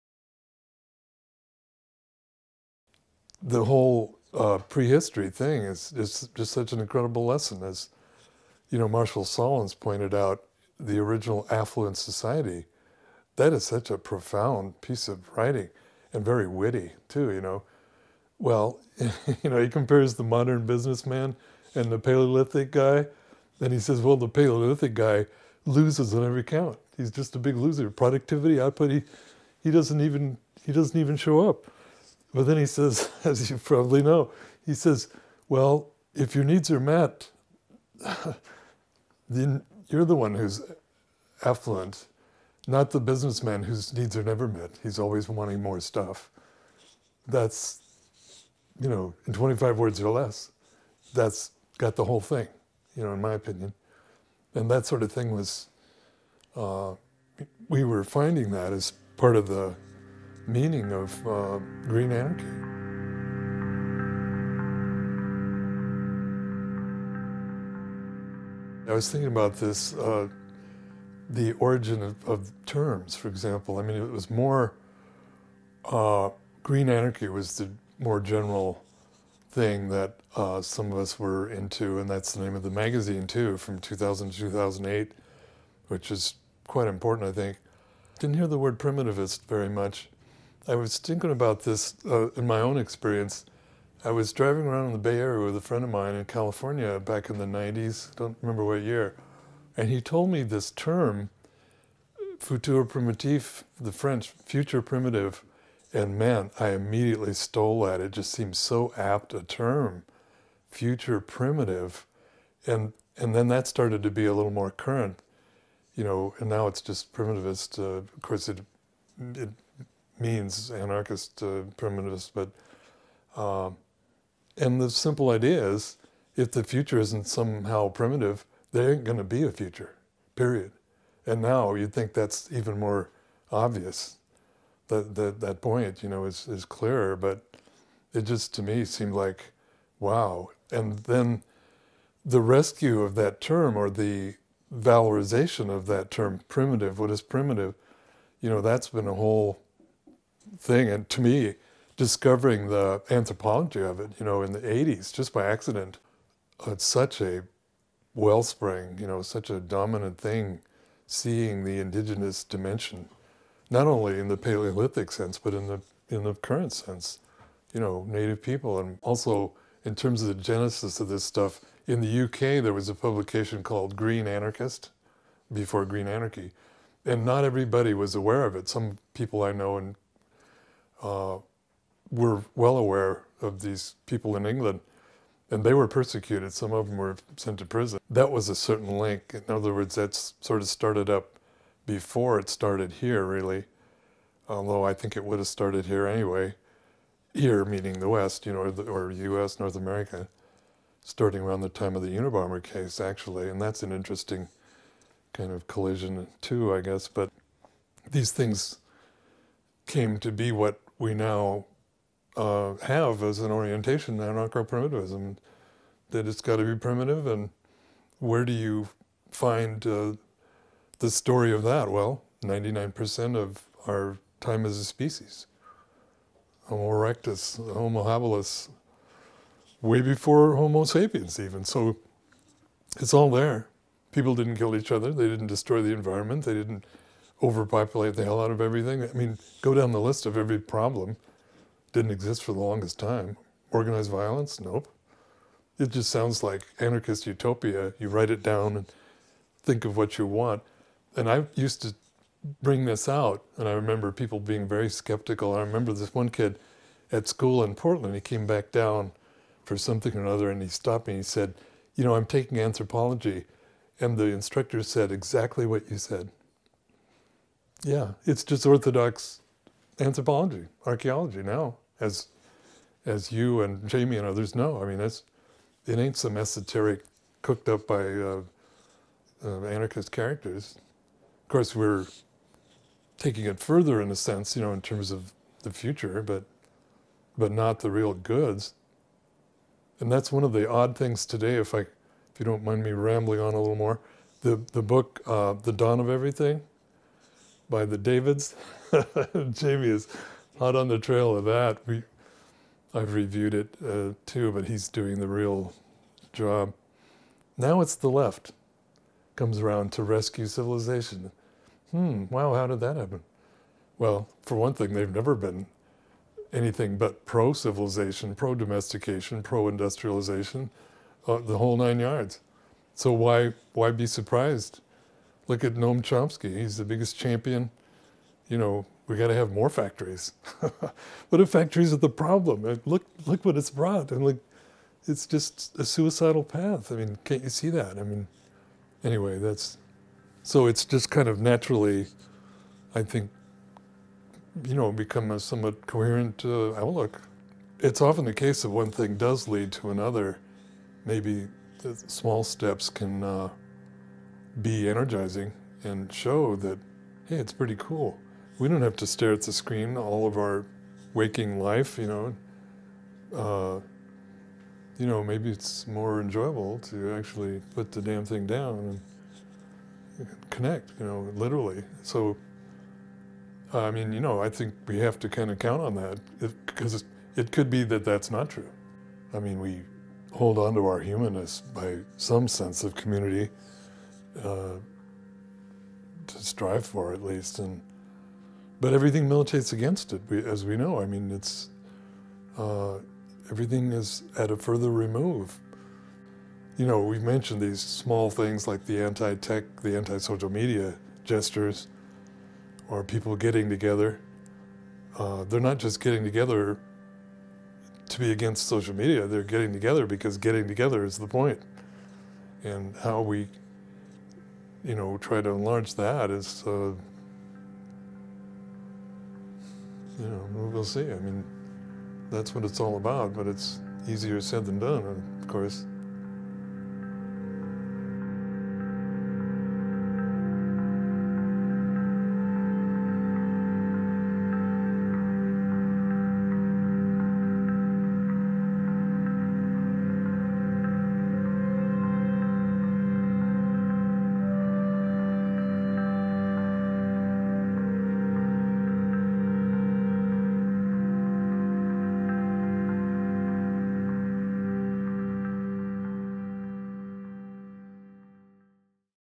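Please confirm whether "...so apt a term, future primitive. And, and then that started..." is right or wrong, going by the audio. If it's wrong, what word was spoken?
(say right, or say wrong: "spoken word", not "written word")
right.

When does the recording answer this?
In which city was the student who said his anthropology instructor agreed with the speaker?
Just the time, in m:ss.
4:17.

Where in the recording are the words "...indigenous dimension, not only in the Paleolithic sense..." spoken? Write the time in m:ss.
2:41.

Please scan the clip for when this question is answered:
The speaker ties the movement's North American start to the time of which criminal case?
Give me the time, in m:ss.
3:22.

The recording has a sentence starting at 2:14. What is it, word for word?
That, that, that point, you know, is, is clearer, but it just to me seemed like, wow.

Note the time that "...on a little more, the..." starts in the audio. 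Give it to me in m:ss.
4:53.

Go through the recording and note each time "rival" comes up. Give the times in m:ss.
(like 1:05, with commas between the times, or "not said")
not said.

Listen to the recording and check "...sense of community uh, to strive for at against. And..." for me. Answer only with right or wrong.
wrong.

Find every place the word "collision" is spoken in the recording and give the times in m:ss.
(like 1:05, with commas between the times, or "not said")
3:25.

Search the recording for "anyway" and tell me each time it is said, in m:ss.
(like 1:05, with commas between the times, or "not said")
3:16, 5:39.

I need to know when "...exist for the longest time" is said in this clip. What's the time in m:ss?
4:02.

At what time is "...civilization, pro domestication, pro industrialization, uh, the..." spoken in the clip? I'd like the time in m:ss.
5:17.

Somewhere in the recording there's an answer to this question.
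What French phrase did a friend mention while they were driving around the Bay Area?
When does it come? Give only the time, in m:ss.
1:42.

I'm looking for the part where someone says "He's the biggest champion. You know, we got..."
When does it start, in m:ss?
5:26.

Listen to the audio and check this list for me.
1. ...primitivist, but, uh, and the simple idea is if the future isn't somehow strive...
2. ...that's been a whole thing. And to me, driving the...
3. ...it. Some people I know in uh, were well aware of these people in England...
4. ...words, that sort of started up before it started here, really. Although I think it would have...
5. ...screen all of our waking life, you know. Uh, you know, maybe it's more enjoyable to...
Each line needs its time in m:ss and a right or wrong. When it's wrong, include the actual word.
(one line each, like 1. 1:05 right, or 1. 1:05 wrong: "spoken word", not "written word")
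1. 2:01 wrong: "primitive", not "strive"
2. 2:28 wrong: "discovering", not "driving"
3. 2:58 right
4. 3:09 right
5. 5:59 right.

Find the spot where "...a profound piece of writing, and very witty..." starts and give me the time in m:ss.
0:13.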